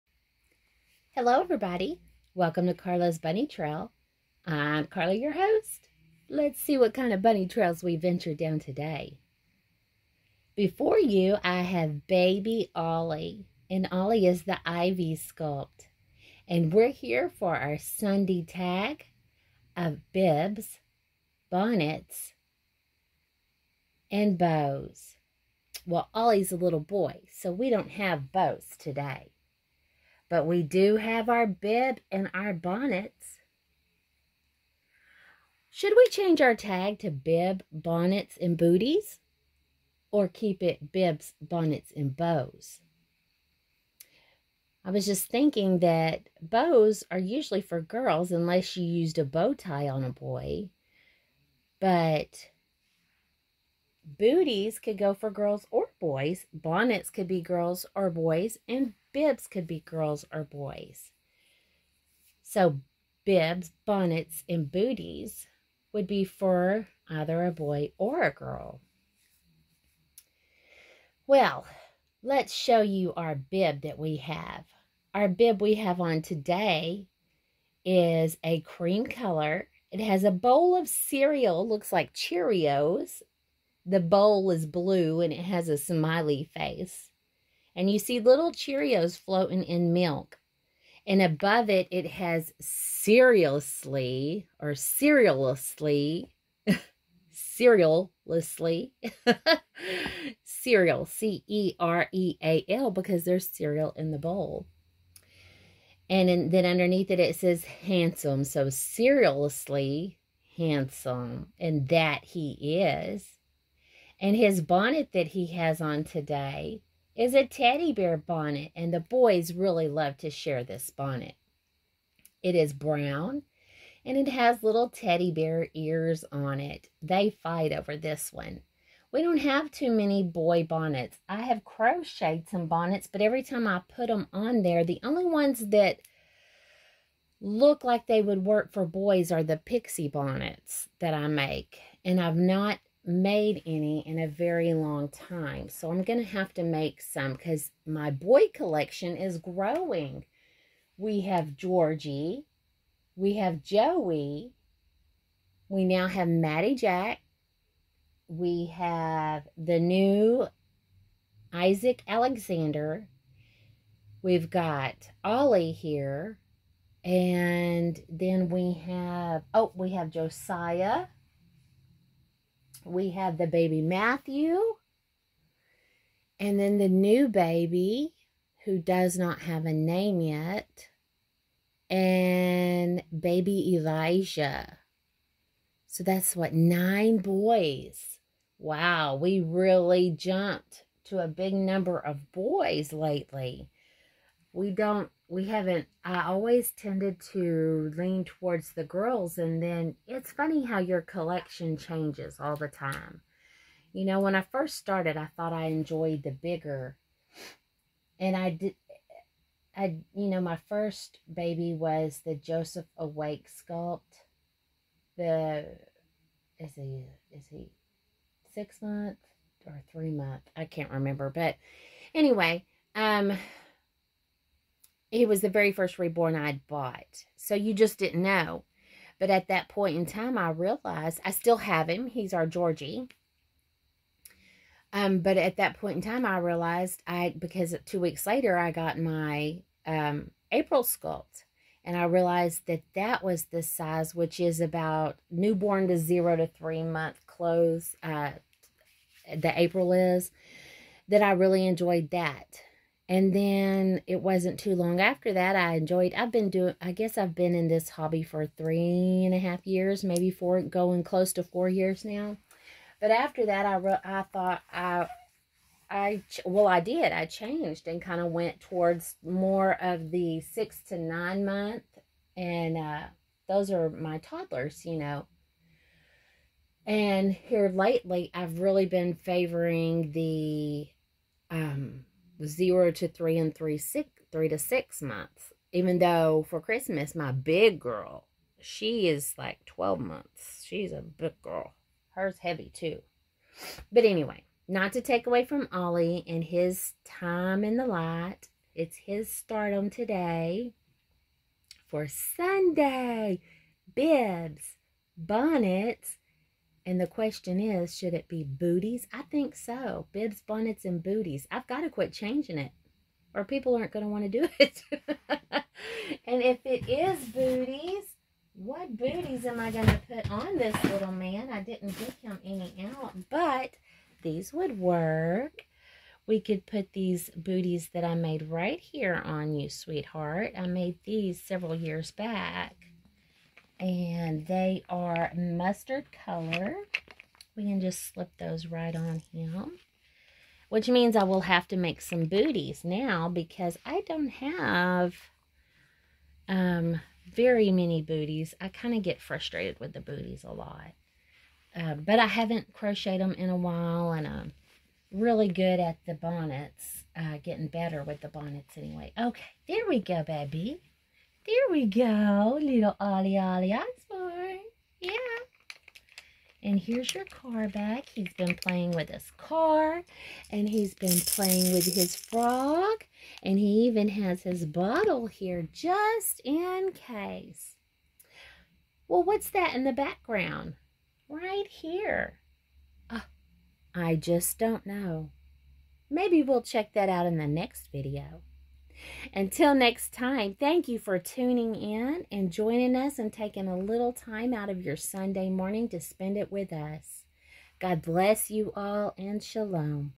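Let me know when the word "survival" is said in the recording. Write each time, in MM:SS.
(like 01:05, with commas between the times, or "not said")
not said.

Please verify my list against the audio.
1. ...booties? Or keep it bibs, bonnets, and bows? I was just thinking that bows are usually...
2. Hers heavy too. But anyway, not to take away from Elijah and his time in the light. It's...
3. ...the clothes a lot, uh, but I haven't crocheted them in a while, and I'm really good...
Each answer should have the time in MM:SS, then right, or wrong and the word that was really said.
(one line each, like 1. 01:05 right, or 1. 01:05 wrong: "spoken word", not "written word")
1. 00:38 right
2. 04:52 wrong: "Ollie", not "Elijah"
3. 05:49 wrong: "booties", not "clothes".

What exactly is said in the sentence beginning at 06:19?
Well, what's that in the background?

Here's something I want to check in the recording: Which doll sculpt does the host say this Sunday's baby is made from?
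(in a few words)
Ivy.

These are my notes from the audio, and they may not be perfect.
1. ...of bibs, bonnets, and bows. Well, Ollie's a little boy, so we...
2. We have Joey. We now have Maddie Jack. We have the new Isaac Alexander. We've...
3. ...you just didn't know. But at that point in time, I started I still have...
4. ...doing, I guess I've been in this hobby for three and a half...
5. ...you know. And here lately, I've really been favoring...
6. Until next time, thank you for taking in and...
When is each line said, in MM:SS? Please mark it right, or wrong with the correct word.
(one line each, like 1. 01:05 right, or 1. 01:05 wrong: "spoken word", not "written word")
1. 00:19 right
2. 02:33 right
3. 03:47 wrong: "realized", not "started"
4. 04:16 right
5. 04:34 right
6. 06:29 wrong: "tuning", not "taking".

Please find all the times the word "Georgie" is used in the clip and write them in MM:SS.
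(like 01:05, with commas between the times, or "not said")
02:31, 03:52.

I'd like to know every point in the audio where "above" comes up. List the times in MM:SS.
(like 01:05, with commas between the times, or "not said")
01:31.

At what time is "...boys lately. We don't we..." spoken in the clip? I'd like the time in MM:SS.
03:12.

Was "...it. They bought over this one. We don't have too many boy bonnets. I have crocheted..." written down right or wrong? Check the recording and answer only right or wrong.
wrong.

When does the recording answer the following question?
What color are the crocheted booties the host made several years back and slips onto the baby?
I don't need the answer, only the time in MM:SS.
05:35.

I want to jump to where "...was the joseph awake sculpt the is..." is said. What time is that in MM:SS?
03:31.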